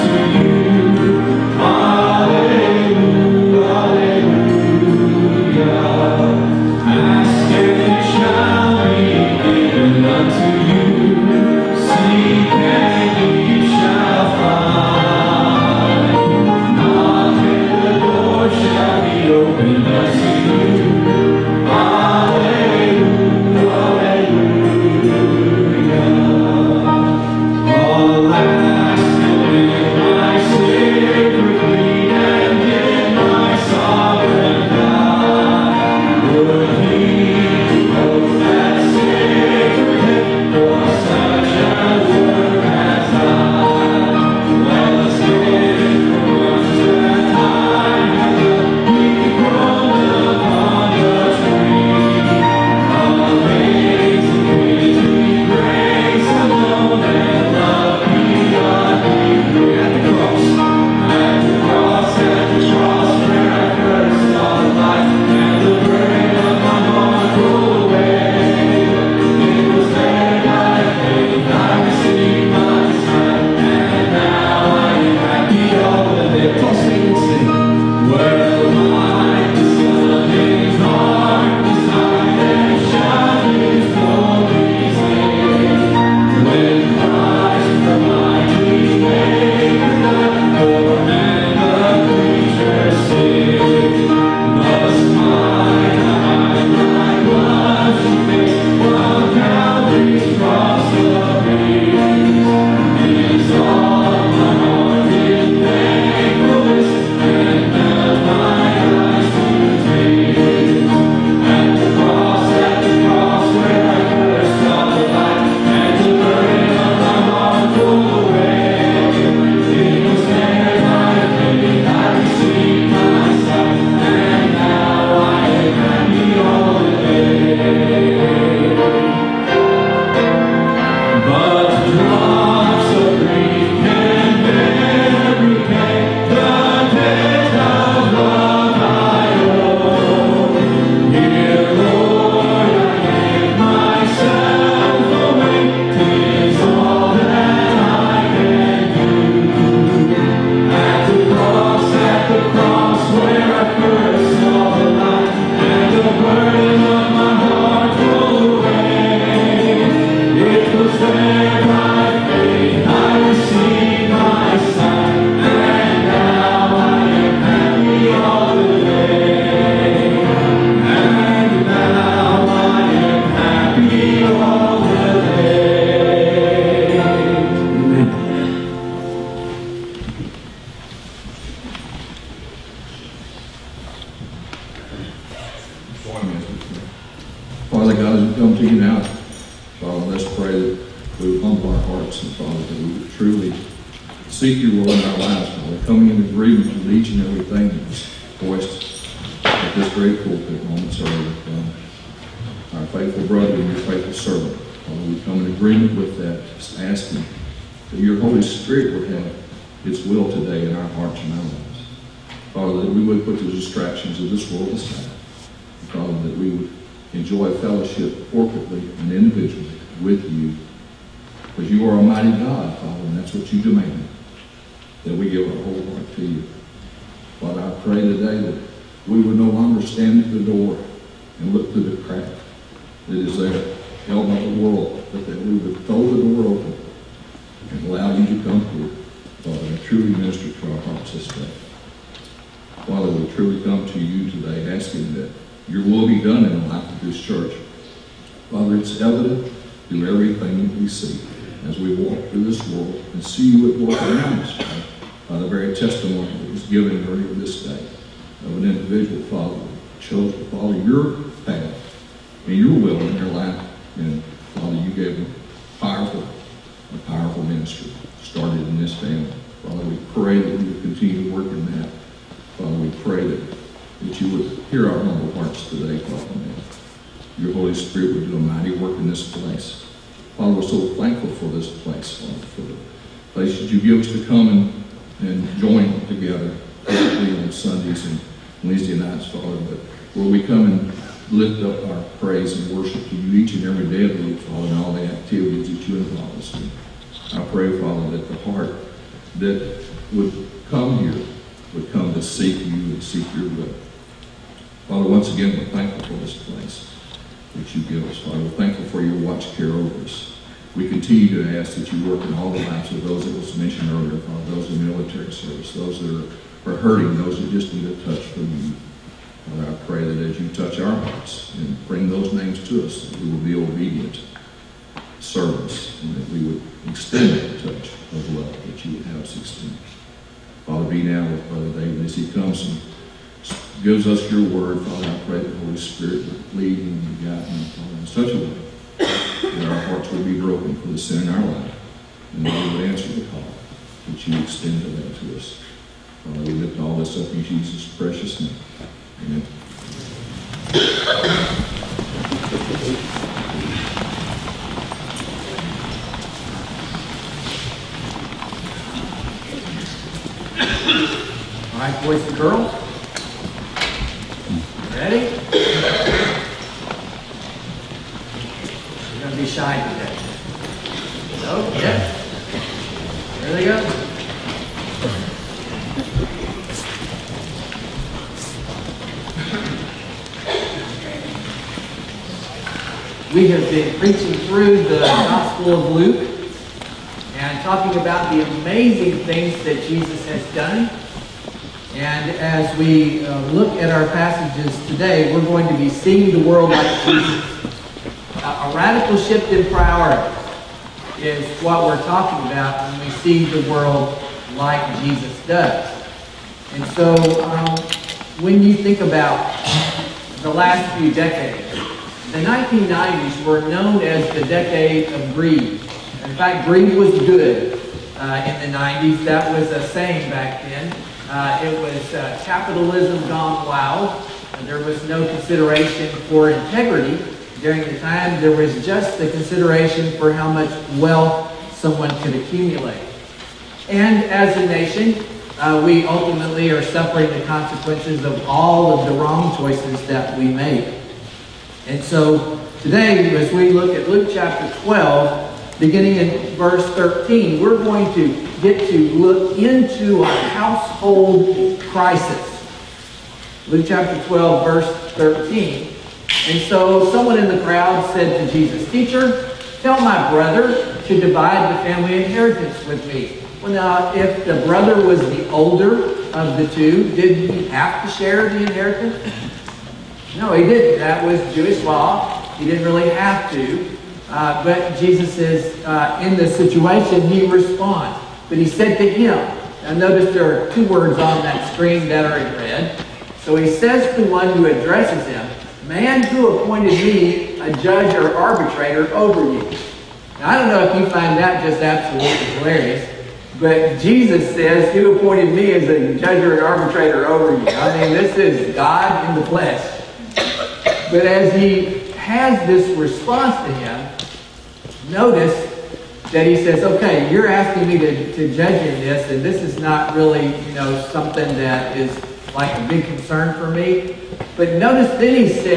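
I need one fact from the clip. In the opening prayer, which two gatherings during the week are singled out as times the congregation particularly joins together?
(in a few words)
Sundays and Wednesday nights.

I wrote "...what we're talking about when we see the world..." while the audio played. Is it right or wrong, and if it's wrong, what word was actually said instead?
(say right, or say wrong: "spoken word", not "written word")
right.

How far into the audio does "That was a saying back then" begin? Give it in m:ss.
6:59.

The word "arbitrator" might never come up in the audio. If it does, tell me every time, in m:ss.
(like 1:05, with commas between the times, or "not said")
8:08, 8:16.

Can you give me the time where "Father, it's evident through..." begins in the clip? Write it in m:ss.
4:08.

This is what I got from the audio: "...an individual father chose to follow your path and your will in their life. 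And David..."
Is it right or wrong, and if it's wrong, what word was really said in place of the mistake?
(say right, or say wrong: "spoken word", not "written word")
wrong: "Father", not "David".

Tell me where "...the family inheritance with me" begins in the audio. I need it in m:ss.
7:41.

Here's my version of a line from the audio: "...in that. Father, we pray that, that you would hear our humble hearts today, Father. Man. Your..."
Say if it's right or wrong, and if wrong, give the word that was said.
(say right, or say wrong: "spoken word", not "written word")
right.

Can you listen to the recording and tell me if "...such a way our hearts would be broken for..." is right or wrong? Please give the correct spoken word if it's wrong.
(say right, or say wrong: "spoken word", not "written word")
right.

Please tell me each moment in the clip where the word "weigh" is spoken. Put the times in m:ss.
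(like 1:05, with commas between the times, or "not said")
not said.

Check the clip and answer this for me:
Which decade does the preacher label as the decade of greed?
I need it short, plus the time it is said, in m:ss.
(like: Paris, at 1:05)
1990s, at 6:52.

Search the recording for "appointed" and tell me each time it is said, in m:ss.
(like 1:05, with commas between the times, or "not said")
8:06, 8:15.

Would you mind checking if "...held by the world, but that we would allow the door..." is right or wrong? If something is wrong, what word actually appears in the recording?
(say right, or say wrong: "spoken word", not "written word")
wrong: "throw", not "allow".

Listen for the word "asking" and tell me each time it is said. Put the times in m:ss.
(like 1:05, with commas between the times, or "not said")
3:26, 4:04, 8:27.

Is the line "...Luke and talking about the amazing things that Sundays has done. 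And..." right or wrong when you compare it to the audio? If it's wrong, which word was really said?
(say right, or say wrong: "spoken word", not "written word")
wrong: "Jesus", not "Sundays".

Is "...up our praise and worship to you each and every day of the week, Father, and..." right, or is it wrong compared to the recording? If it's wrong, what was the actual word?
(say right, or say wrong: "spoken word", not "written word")
right.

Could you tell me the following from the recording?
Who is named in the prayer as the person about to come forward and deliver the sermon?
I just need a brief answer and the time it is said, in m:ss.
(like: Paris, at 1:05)
Brother David, at 5:31.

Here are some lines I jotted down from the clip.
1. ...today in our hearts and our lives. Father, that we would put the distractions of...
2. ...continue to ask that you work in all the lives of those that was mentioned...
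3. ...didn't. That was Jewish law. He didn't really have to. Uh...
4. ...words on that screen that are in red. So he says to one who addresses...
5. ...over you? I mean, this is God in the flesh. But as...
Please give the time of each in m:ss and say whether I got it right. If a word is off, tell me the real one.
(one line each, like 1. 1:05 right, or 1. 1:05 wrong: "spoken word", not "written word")
1. 3:30 right
2. 5:10 right
3. 7:50 right
4. 8:00 right
5. 8:17 right.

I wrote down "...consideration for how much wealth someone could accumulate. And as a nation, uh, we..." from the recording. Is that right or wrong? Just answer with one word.
right.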